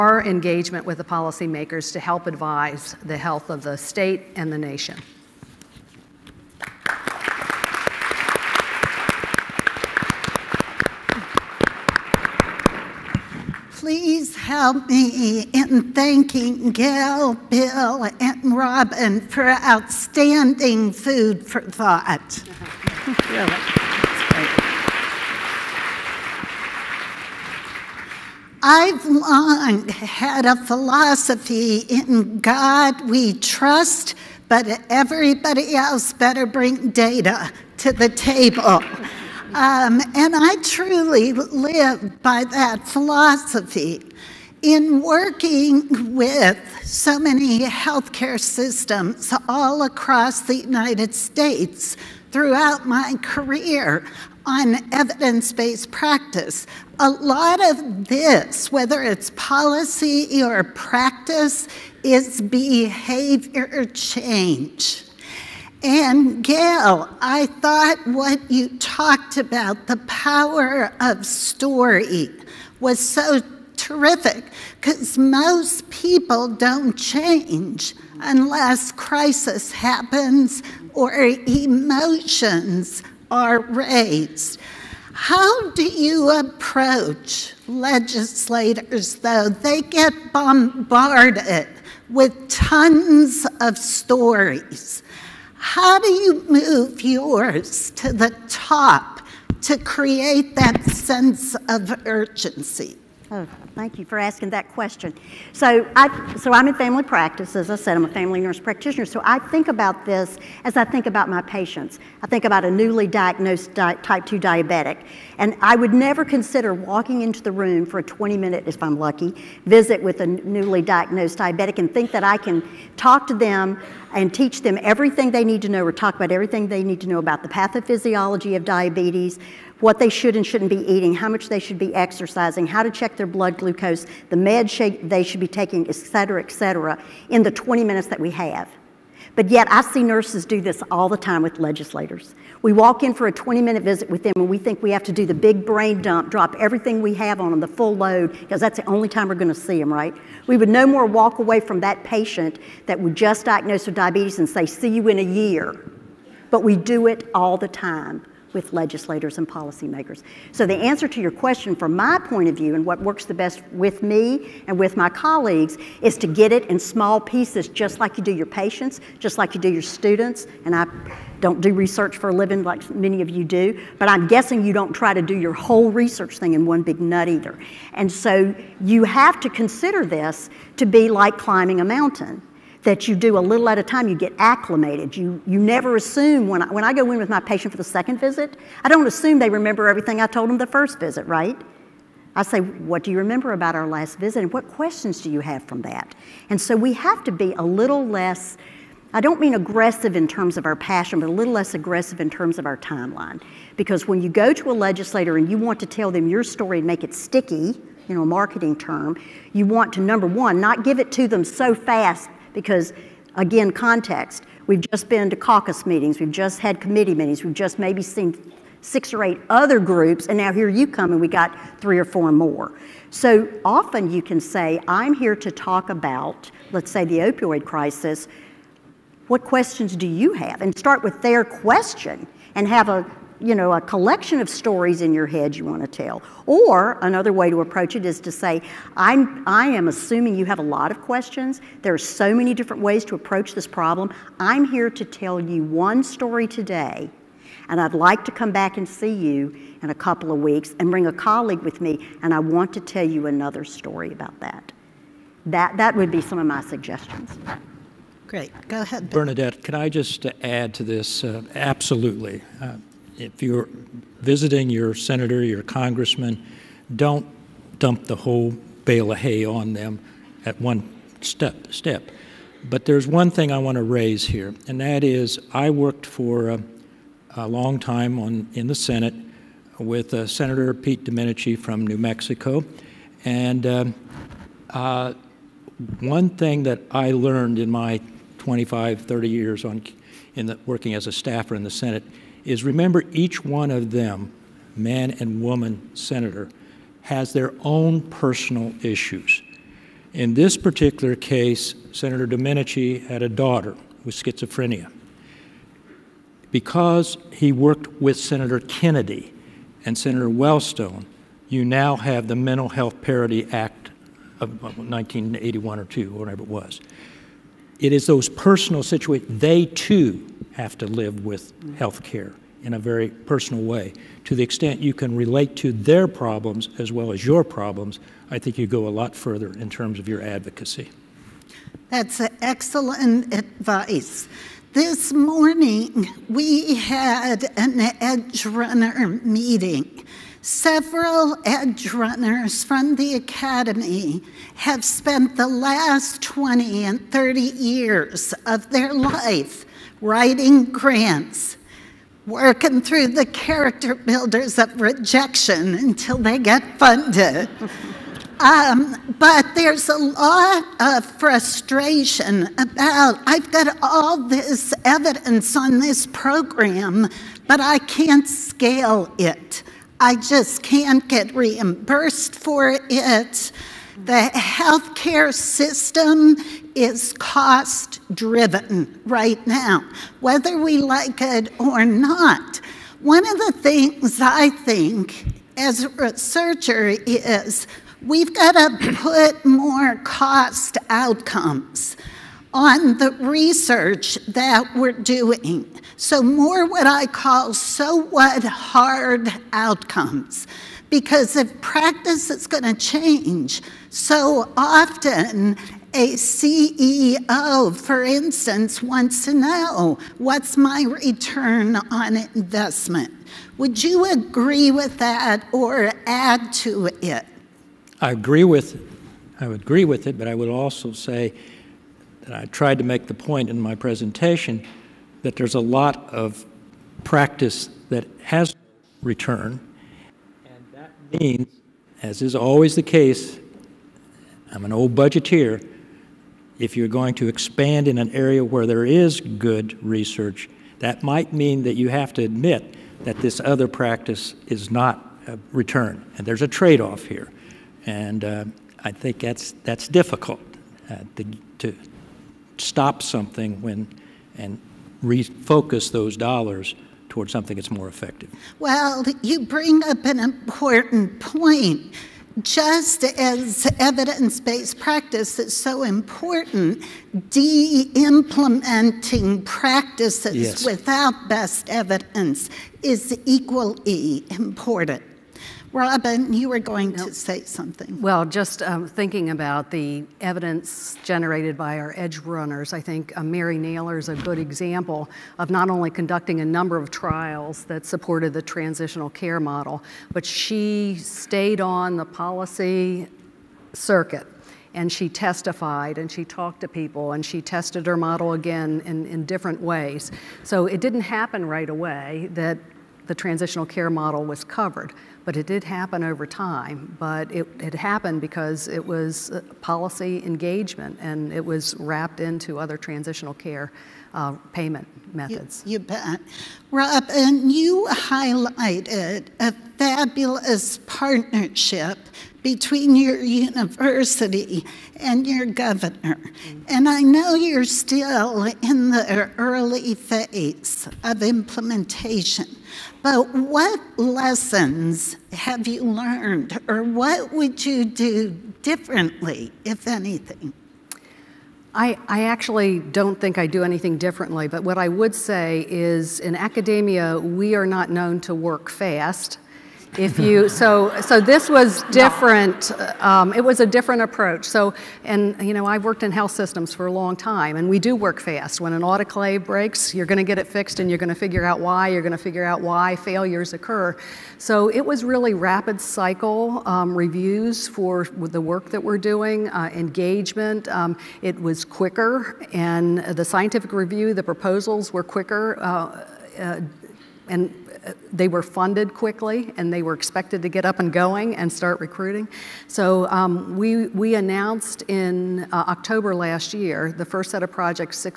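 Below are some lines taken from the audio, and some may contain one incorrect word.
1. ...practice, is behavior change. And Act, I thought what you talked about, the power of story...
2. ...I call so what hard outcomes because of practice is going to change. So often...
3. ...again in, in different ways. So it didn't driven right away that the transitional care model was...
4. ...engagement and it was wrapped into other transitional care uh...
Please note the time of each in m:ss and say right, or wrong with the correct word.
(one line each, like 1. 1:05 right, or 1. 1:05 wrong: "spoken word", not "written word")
1. 1:00 wrong: "Gale", not "Act"
2. 6:36 right
3. 8:18 wrong: "happen", not "driven"
4. 8:30 right.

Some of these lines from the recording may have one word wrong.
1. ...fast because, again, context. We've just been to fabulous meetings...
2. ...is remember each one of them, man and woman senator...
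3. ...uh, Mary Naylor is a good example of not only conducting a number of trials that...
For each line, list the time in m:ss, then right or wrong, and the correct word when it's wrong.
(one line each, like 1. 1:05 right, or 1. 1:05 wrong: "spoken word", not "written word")
1. 3:31 wrong: "caucus", not "fabulous"
2. 4:52 right
3. 8:03 right.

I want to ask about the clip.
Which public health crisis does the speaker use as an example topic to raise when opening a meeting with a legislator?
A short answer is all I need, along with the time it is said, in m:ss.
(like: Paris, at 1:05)
opioid crisis, at 3:47.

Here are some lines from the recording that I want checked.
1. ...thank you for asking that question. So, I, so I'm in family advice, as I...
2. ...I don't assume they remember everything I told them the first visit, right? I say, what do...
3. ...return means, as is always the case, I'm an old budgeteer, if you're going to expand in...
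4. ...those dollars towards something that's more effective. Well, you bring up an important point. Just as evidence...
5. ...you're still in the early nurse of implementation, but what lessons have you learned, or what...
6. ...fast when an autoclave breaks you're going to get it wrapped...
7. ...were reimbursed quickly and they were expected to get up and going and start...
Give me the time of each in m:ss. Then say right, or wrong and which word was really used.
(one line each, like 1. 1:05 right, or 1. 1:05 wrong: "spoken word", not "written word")
1. 1:43 wrong: "practice", not "advice"
2. 3:08 right
3. 7:09 right
4. 7:35 right
5. 8:47 wrong: "phase", not "nurse"
6. 9:18 wrong: "fixed", not "wrapped"
7. 9:38 wrong: "funded", not "reimbursed".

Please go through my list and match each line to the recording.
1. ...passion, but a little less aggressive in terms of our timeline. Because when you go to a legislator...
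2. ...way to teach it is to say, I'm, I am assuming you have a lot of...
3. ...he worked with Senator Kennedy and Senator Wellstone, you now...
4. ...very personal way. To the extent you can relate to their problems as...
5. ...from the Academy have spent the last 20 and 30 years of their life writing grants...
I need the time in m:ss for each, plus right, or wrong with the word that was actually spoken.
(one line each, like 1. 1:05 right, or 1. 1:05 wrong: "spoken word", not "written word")
1. 3:20 right
2. 3:57 wrong: "approach", not "teach"
3. 5:07 right
4. 5:22 right
5. 5:42 right.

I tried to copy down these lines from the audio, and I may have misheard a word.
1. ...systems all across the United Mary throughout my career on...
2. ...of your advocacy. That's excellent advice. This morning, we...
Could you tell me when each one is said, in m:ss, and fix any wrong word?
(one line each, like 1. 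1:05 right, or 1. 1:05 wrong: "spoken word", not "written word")
1. 0:48 wrong: "States", not "Mary"
2. 5:29 right.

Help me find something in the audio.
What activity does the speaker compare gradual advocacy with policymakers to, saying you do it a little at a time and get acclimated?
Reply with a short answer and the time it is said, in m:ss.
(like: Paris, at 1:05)
climbing a mountain, at 3:01.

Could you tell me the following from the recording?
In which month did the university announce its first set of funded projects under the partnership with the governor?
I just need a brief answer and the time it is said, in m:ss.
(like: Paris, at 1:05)
October, at 9:45.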